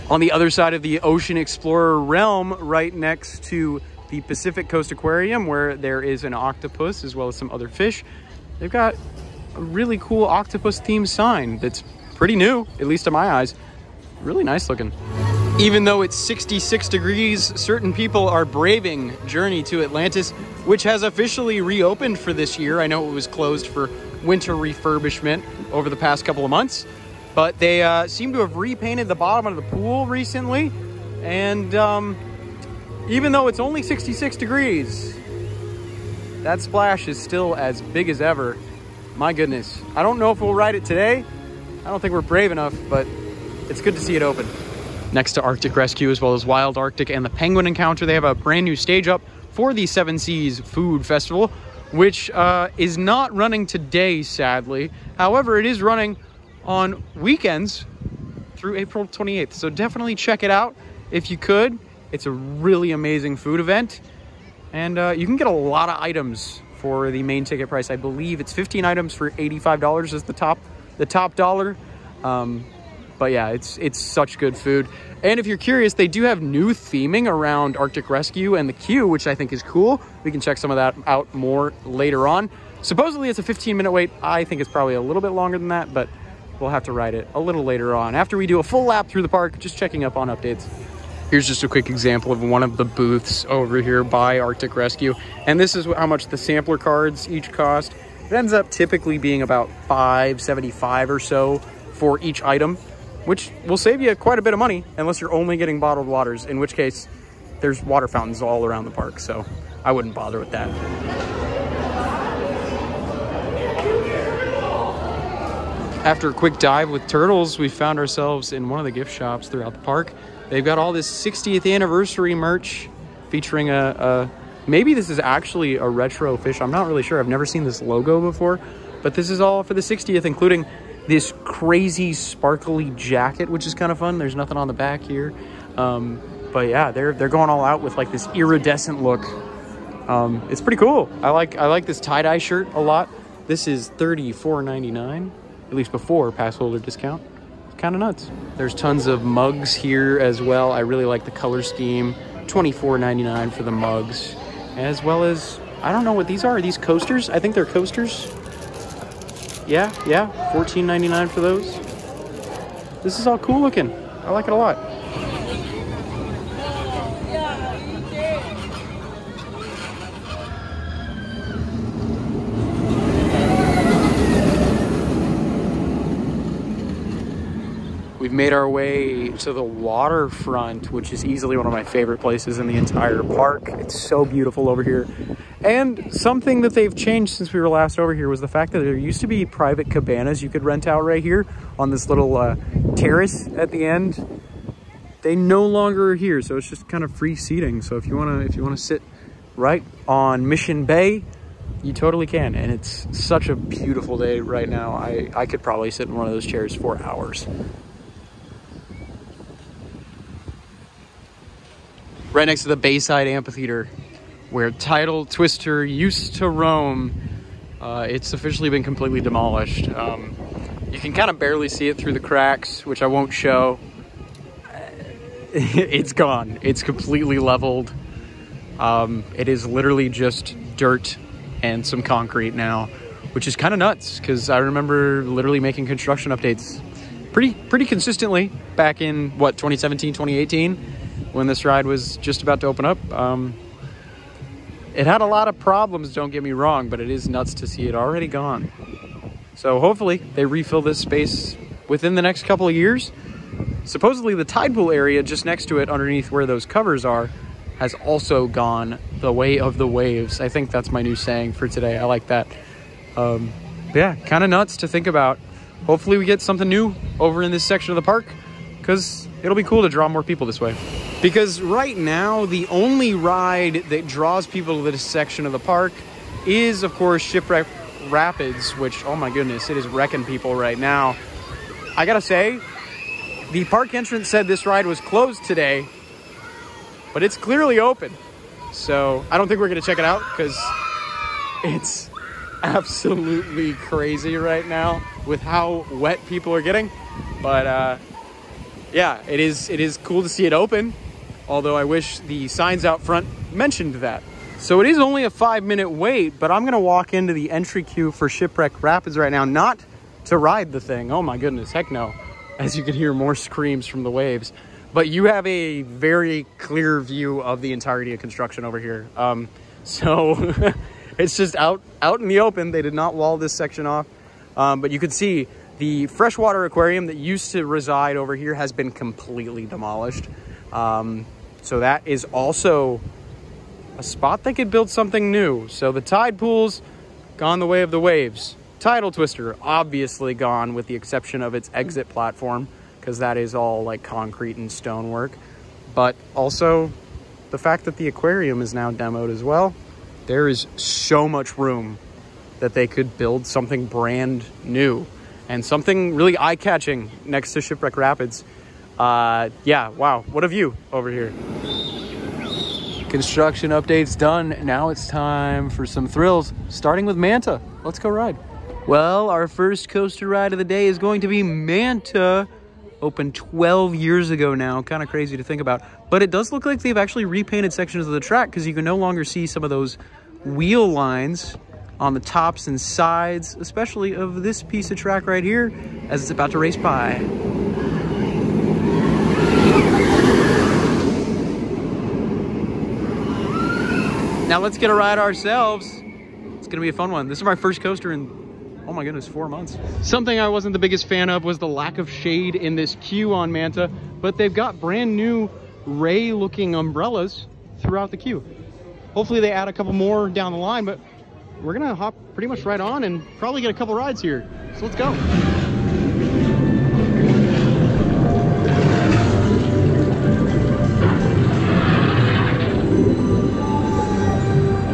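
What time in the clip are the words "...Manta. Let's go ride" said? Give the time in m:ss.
6:07.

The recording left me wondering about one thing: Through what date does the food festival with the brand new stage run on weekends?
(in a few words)
April 28th.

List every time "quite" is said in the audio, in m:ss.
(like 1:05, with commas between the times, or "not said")
1:44.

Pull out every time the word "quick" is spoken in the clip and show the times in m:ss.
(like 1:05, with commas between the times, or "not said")
1:31, 1:56.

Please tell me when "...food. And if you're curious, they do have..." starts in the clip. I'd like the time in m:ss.
1:14.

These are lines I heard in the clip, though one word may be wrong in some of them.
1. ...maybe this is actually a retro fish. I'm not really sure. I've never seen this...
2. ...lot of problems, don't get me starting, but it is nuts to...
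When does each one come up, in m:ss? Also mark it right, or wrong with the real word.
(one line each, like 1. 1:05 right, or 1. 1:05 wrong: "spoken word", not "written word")
1. 2:04 right
2. 4:05 wrong: "wrong", not "starting".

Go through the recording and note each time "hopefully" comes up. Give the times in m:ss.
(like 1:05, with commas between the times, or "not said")
4:09, 4:25, 6:49.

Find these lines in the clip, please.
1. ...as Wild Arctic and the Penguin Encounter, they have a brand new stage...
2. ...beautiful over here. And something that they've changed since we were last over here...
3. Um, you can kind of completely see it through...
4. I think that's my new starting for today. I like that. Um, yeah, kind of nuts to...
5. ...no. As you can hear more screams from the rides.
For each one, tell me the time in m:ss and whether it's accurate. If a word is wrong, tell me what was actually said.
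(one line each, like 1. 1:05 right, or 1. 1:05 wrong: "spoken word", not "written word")
1. 0:46 right
2. 3:04 right
3. 3:39 wrong: "barely", not "completely"
4. 4:20 wrong: "saying", not "starting"
5. 5:11 wrong: "waves", not "rides".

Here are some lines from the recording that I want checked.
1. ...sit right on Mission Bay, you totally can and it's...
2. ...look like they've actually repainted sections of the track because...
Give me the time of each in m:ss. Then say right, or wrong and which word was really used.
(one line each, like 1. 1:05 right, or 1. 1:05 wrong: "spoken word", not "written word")
1. 3:18 right
2. 6:16 right.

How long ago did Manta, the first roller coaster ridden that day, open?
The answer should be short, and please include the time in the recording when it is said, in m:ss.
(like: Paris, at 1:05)
12 years, at 6:13.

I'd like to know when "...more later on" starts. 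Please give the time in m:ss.
1:21.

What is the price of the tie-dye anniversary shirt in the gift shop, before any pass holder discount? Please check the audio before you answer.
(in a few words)
$34.99.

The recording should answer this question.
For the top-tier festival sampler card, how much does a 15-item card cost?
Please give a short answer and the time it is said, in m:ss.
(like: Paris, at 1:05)
$85, at 1:09.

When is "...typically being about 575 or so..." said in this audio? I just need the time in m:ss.
1:38.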